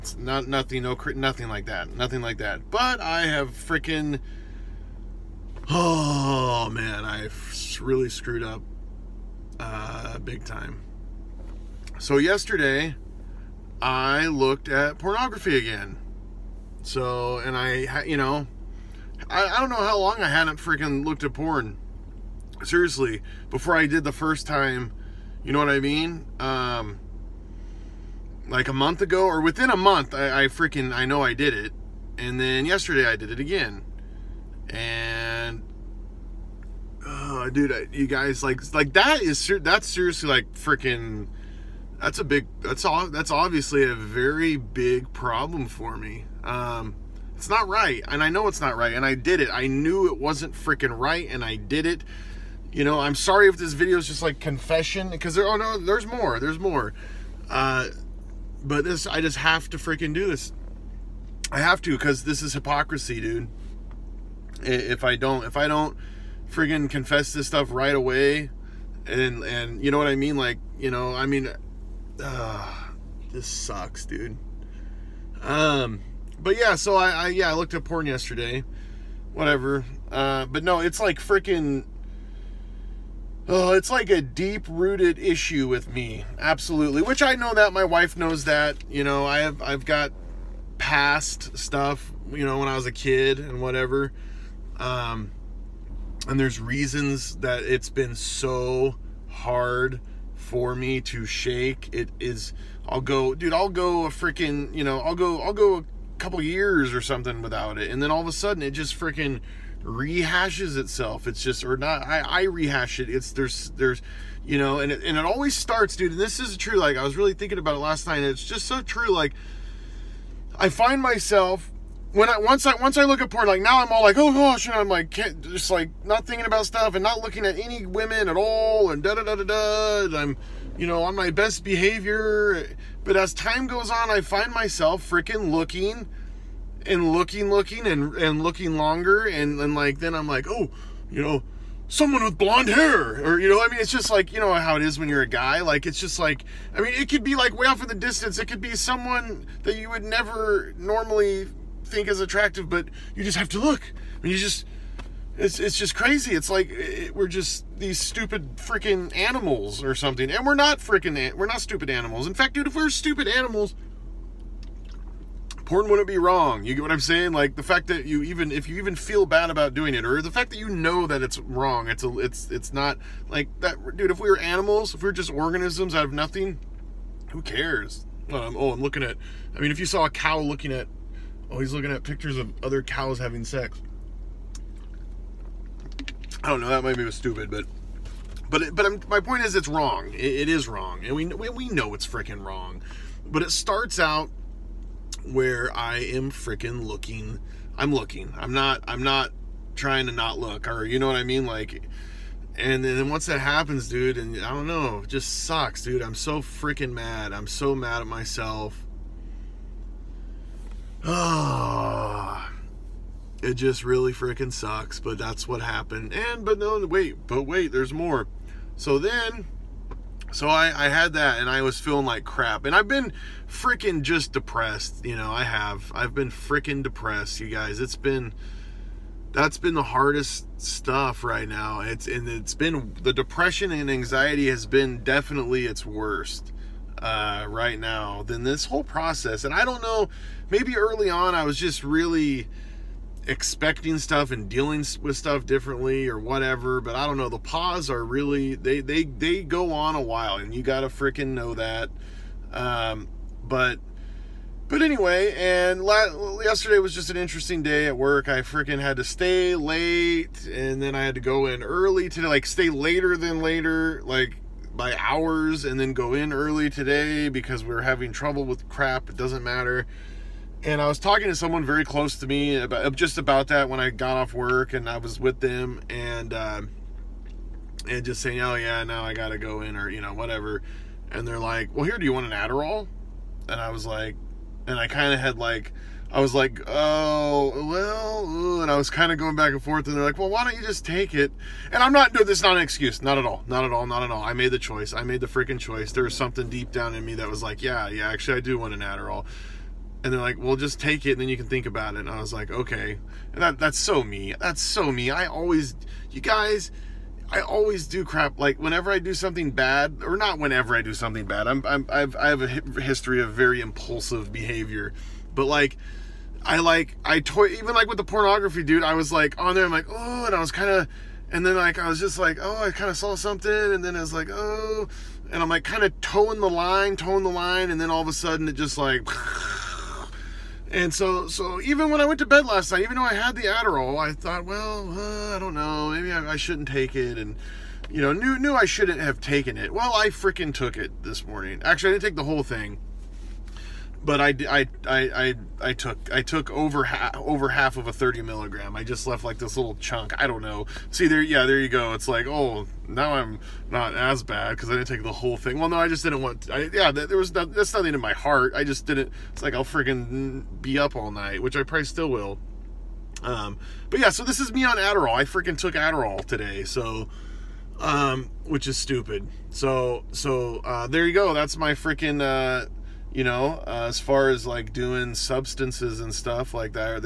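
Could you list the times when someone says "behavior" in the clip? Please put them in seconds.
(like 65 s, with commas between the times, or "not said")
131 s, 314 s.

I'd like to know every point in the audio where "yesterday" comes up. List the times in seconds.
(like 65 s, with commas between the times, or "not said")
12 s, 32 s, 78 s, 256 s.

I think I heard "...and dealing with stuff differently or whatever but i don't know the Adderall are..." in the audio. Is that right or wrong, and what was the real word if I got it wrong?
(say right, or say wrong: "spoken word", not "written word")
wrong: "PAWS", not "Adderall".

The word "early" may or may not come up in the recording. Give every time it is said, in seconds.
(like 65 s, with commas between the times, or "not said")
240 s, 261 s, 266 s.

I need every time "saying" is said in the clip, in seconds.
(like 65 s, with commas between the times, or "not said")
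166 s, 278 s.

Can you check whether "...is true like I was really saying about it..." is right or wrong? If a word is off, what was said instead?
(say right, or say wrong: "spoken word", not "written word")
wrong: "thinking", not "saying".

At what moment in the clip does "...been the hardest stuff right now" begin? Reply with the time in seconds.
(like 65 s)
229 s.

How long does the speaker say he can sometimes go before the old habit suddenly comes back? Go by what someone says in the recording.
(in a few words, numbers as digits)
a couple years.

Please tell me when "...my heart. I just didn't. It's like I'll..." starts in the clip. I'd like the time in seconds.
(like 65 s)
357 s.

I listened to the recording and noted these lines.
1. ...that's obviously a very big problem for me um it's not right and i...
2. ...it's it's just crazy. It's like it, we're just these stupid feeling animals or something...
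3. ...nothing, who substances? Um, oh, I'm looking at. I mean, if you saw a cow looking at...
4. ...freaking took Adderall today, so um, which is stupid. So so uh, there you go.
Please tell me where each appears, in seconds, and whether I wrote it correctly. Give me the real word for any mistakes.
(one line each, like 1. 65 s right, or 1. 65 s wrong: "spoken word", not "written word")
1. 43 s right
2. 155 s wrong: "freaking", not "feeling"
3. 176 s wrong: "cares", not "substances"
4. 365 s right.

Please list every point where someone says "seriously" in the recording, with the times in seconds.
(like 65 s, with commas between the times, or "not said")
22 s, 39 s.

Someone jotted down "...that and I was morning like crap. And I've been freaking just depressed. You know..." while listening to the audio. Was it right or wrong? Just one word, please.
wrong.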